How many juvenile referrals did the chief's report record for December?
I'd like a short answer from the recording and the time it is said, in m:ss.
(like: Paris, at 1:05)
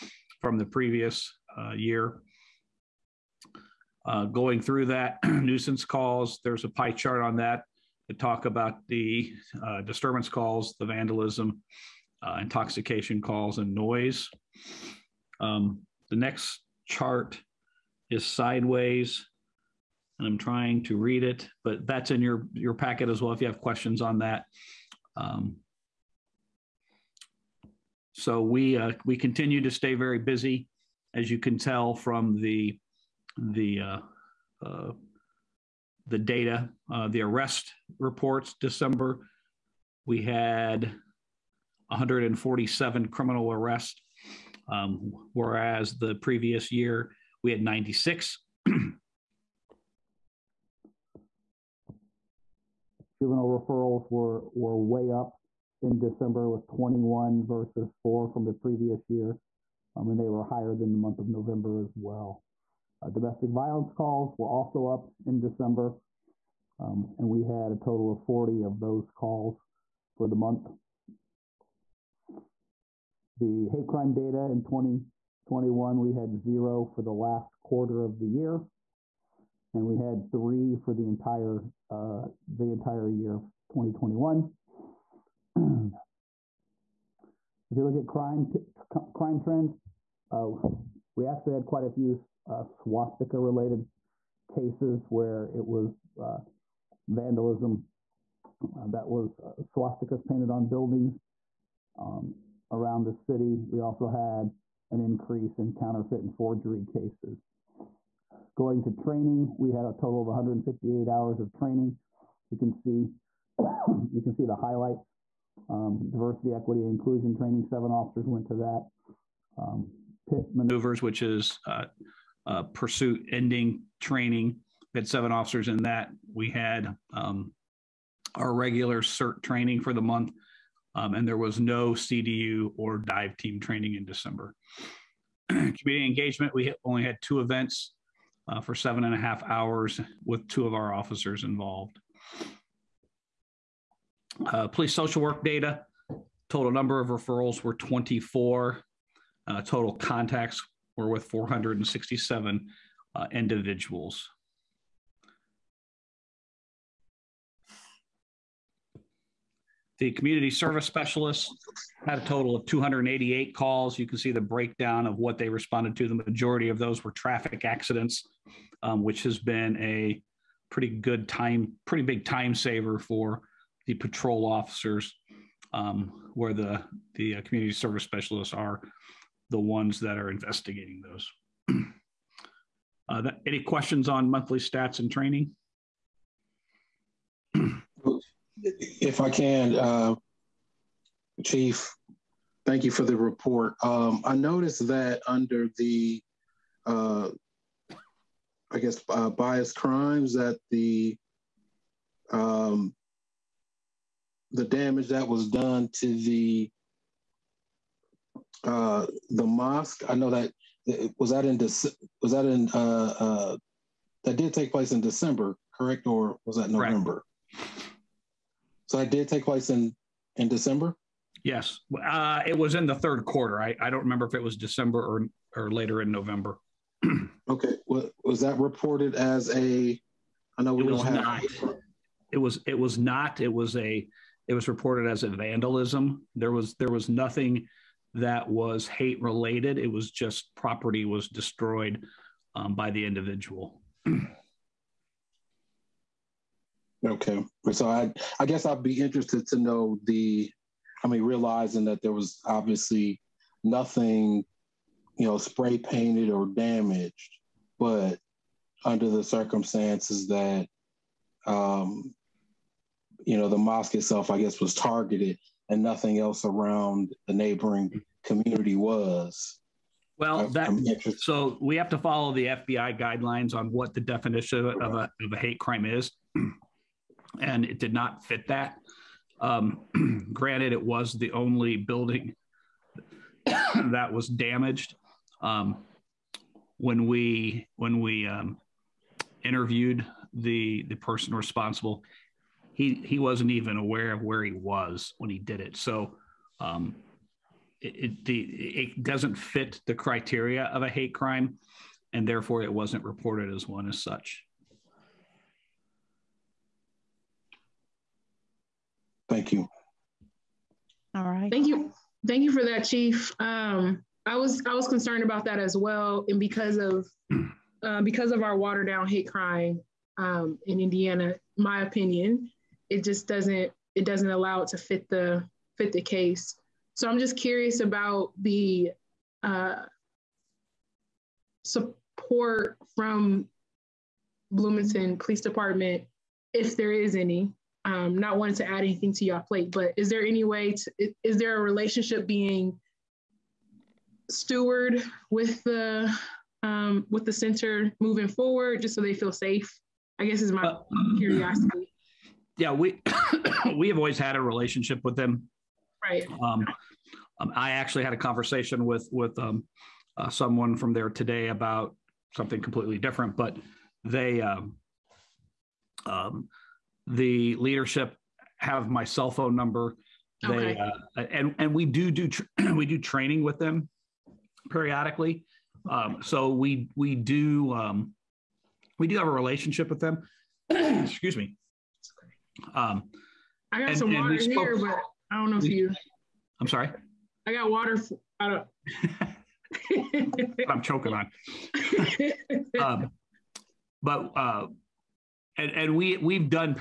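21, at 0:56.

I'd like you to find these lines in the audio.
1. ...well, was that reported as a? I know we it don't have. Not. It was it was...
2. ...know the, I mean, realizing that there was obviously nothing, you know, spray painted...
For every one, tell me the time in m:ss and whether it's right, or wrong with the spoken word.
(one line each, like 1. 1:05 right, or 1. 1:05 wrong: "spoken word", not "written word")
1. 3:47 right
2. 4:09 right.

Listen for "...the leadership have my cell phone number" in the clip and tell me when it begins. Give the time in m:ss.
6:07.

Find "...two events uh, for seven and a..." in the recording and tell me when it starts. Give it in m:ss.
2:17.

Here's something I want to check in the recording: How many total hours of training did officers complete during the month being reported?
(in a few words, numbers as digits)
158.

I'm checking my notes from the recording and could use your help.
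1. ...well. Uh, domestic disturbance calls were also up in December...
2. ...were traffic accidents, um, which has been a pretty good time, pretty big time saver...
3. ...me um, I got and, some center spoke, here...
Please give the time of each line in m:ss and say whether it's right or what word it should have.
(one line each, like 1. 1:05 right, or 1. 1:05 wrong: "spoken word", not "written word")
1. 1:01 wrong: "violence", not "disturbance"
2. 2:47 right
3. 6:21 wrong: "water", not "center".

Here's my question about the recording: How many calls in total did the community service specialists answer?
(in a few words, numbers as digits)
288.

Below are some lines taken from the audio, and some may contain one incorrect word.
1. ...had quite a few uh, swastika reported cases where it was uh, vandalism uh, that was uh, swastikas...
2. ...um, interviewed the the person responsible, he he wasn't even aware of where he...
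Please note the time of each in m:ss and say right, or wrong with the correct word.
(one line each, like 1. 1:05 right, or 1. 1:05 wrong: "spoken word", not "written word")
1. 1:31 wrong: "related", not "reported"
2. 4:48 right.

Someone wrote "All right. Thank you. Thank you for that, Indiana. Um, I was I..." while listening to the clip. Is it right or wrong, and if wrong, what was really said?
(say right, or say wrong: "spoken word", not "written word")
wrong: "Chief", not "Indiana".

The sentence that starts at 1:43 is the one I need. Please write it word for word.
We also had an increase in counterfeit and forgery cases.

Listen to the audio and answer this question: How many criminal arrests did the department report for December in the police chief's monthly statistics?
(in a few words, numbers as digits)
147.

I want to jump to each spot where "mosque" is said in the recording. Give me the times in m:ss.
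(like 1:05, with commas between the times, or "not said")
3:29, 4:23.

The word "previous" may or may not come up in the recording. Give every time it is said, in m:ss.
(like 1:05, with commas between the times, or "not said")
0:00, 0:46, 0:58.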